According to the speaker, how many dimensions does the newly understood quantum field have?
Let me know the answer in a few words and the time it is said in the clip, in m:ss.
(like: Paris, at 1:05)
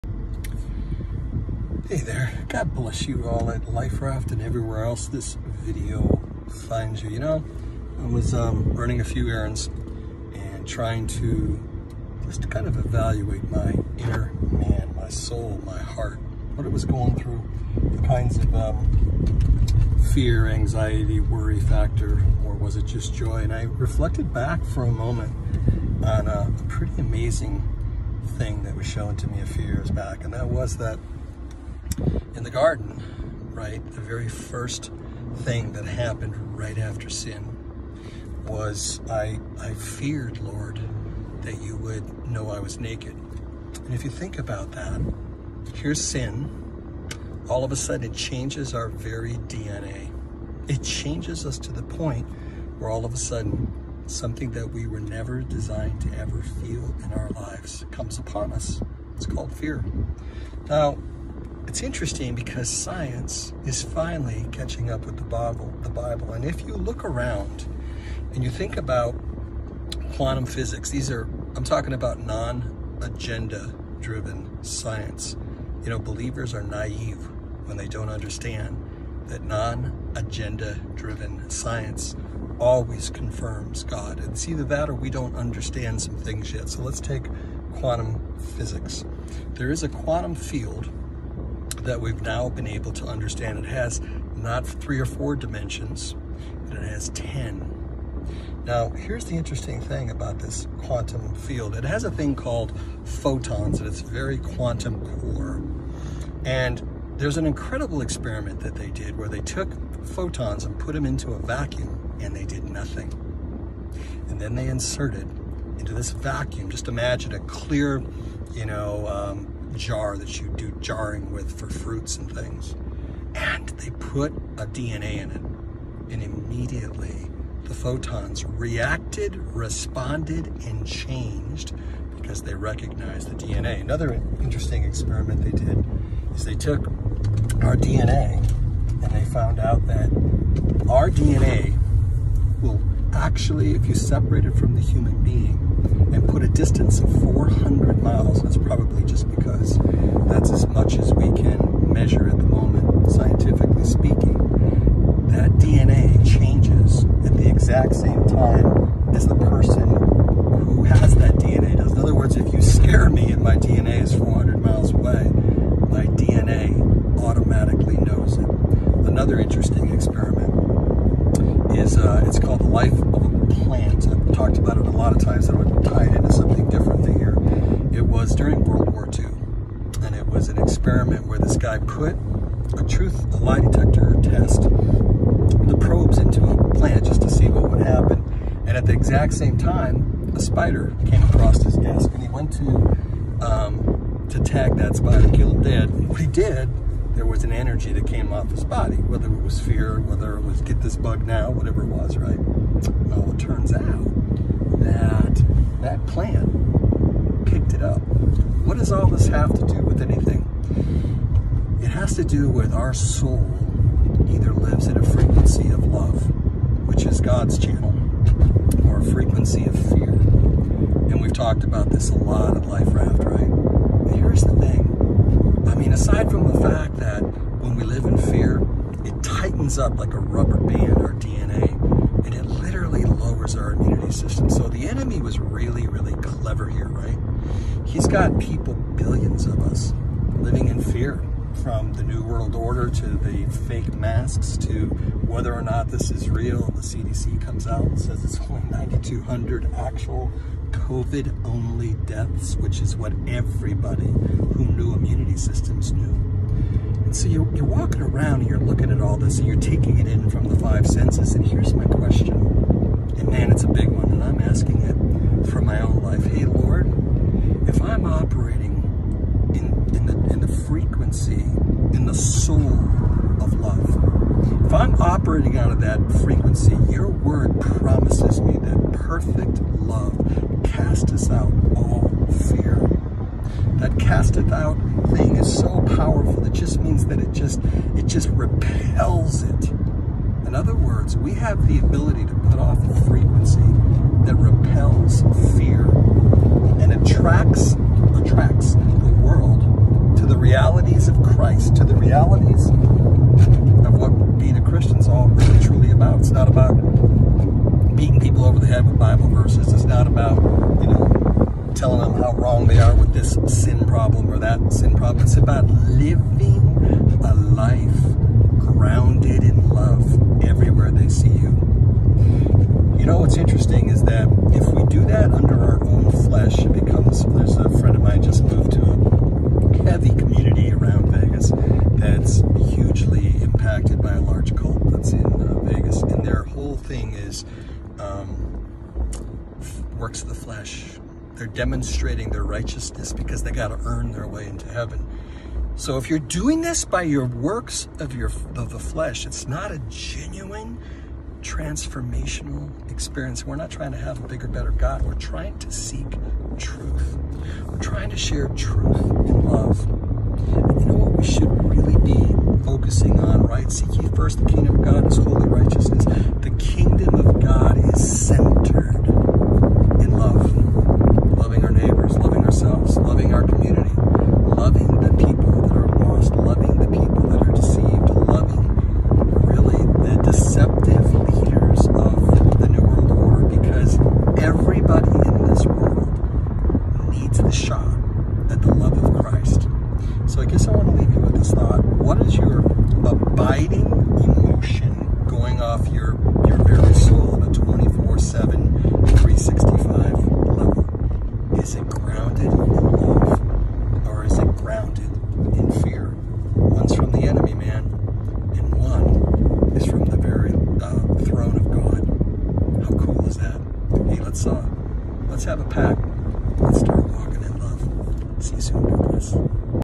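10, at 1:37.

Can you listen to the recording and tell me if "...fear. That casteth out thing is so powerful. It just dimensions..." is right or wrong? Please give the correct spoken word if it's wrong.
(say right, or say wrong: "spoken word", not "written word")
wrong: "means", not "dimensions".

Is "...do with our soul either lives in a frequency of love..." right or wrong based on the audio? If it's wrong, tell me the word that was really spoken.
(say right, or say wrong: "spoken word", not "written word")
right.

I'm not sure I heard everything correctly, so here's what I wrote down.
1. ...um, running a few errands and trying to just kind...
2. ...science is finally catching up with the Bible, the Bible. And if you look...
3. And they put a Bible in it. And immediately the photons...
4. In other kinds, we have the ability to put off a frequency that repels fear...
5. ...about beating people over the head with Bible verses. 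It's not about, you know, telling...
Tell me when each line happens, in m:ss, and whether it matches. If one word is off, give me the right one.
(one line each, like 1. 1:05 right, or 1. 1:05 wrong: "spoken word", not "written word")
1. 0:08 right
2. 1:02 right
3. 2:03 wrong: "DNA", not "Bible"
4. 4:50 wrong: "words", not "kinds"
5. 5:06 right.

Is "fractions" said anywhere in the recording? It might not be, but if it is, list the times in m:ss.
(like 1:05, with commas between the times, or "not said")
not said.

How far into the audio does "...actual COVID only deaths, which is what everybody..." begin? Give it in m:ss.
4:09.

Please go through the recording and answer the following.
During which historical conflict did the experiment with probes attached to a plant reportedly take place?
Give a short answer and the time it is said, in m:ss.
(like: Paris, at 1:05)
World War II, at 2:58.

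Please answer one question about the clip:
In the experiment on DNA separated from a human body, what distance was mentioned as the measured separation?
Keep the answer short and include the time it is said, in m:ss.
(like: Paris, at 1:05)
400 miles, at 2:27.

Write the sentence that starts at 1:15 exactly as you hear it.
You know, believers are naive when they don't understand that non-agenda driven science always confirms God.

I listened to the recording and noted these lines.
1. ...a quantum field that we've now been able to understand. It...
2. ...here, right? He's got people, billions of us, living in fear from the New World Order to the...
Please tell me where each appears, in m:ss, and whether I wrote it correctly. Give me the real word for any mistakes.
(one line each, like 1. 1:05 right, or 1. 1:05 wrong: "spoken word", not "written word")
1. 1:29 right
2. 3:56 right.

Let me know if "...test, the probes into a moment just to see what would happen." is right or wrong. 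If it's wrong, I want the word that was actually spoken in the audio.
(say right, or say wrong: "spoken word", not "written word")
wrong: "plant", not "moment".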